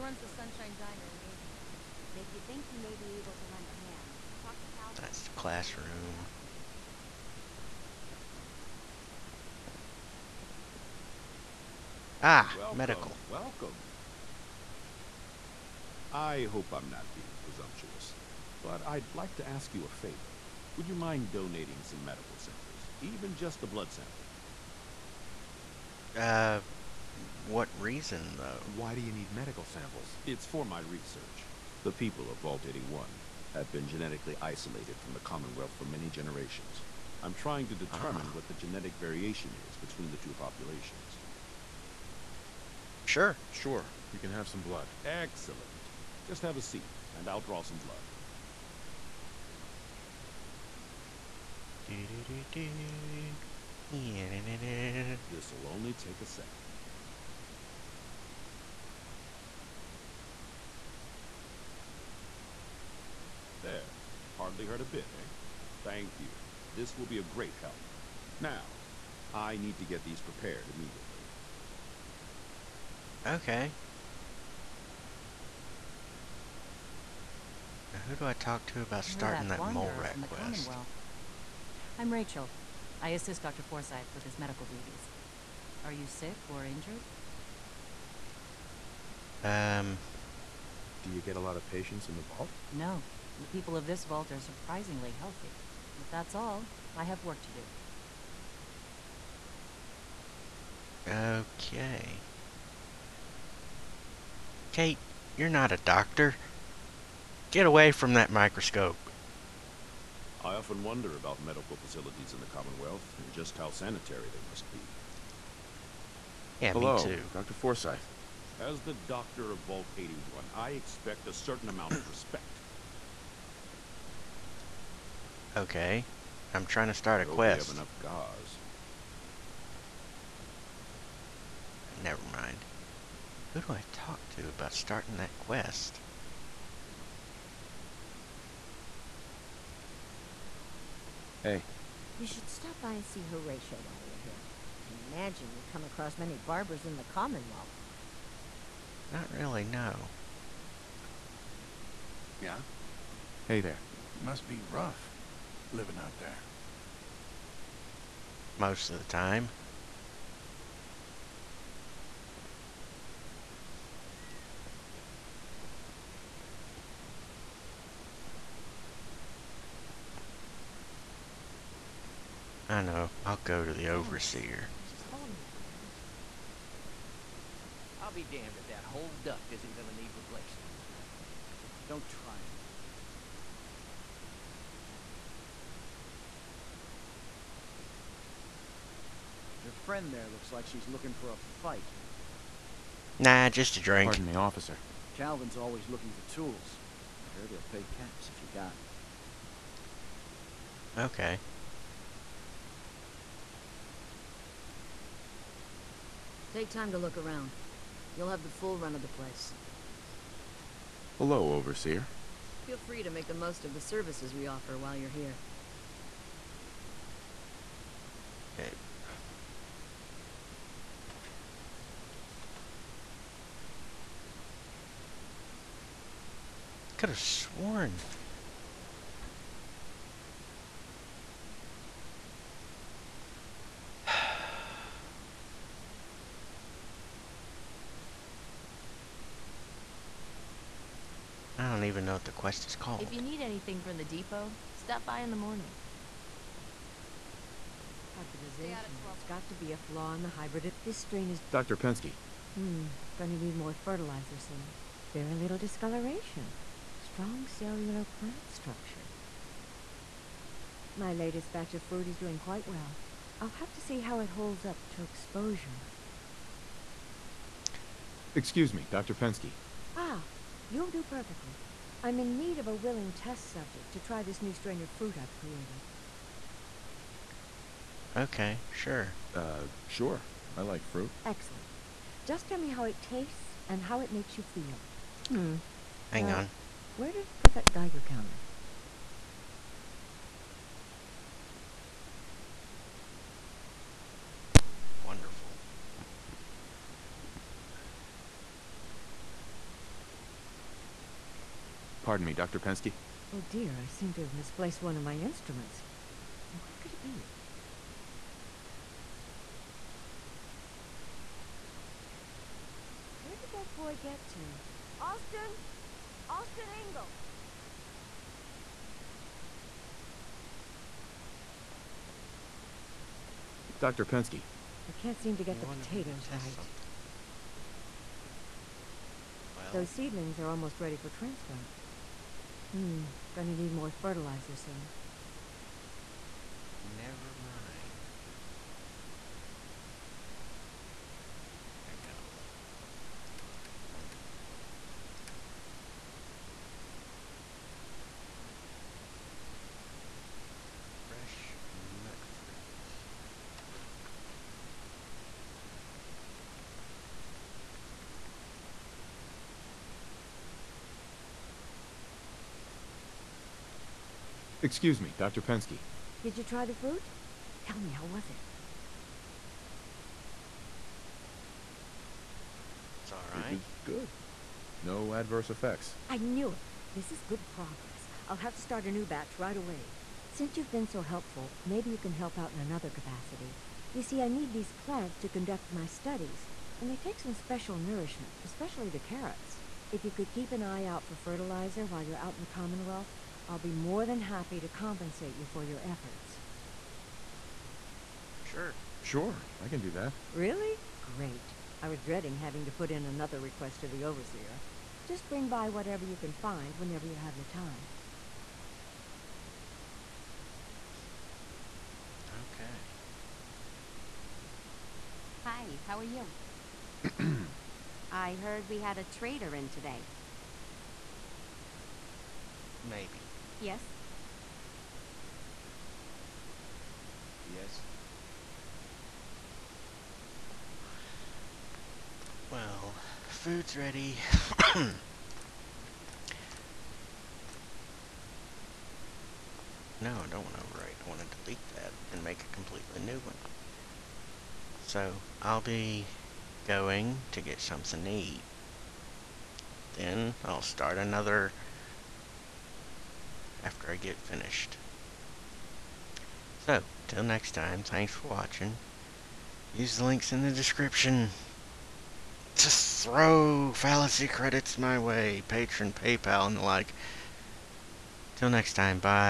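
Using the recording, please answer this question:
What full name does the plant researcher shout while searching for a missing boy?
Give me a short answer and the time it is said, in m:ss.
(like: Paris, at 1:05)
Austin Engle, at 5:16.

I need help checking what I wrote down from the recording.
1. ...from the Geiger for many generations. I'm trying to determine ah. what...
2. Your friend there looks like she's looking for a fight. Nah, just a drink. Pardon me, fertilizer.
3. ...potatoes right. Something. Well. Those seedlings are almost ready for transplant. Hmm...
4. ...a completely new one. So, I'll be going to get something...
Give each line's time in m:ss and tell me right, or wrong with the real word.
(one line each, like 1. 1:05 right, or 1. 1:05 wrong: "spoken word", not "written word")
1. 0:34 wrong: "Commonwealth", not "Geiger"
2. 3:09 wrong: "officer", not "fertilizer"
3. 5:25 right
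4. 7:22 right.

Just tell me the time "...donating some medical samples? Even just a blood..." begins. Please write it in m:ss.
0:21.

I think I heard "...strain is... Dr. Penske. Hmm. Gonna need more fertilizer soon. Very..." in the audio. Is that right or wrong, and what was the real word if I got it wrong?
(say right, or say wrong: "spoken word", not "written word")
right.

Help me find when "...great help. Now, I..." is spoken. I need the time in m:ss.
1:07.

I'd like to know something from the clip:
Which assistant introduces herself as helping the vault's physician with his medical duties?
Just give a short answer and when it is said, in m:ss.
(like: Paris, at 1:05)
Rachel, at 1:22.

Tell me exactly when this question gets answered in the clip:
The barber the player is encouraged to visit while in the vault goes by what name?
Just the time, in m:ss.
2:23.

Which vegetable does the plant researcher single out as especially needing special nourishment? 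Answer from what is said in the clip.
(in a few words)
Carrots.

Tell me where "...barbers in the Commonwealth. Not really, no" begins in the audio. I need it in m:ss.
2:26.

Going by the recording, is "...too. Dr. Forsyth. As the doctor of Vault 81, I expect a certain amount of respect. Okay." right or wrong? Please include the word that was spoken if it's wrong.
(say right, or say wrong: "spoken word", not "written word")
right.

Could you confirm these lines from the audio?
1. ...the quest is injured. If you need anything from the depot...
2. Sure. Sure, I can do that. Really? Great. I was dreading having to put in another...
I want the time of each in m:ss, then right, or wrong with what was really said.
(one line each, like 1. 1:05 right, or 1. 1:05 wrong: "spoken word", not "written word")
1. 4:02 wrong: "called", not "injured"
2. 6:38 right.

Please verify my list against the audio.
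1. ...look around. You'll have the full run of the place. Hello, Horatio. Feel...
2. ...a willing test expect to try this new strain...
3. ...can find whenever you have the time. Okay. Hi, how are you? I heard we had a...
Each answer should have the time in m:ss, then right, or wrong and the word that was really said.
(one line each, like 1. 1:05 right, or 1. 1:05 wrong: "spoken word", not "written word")
1. 3:26 wrong: "Overseer", not "Horatio"
2. 4:32 wrong: "subject", not "expect"
3. 6:46 right.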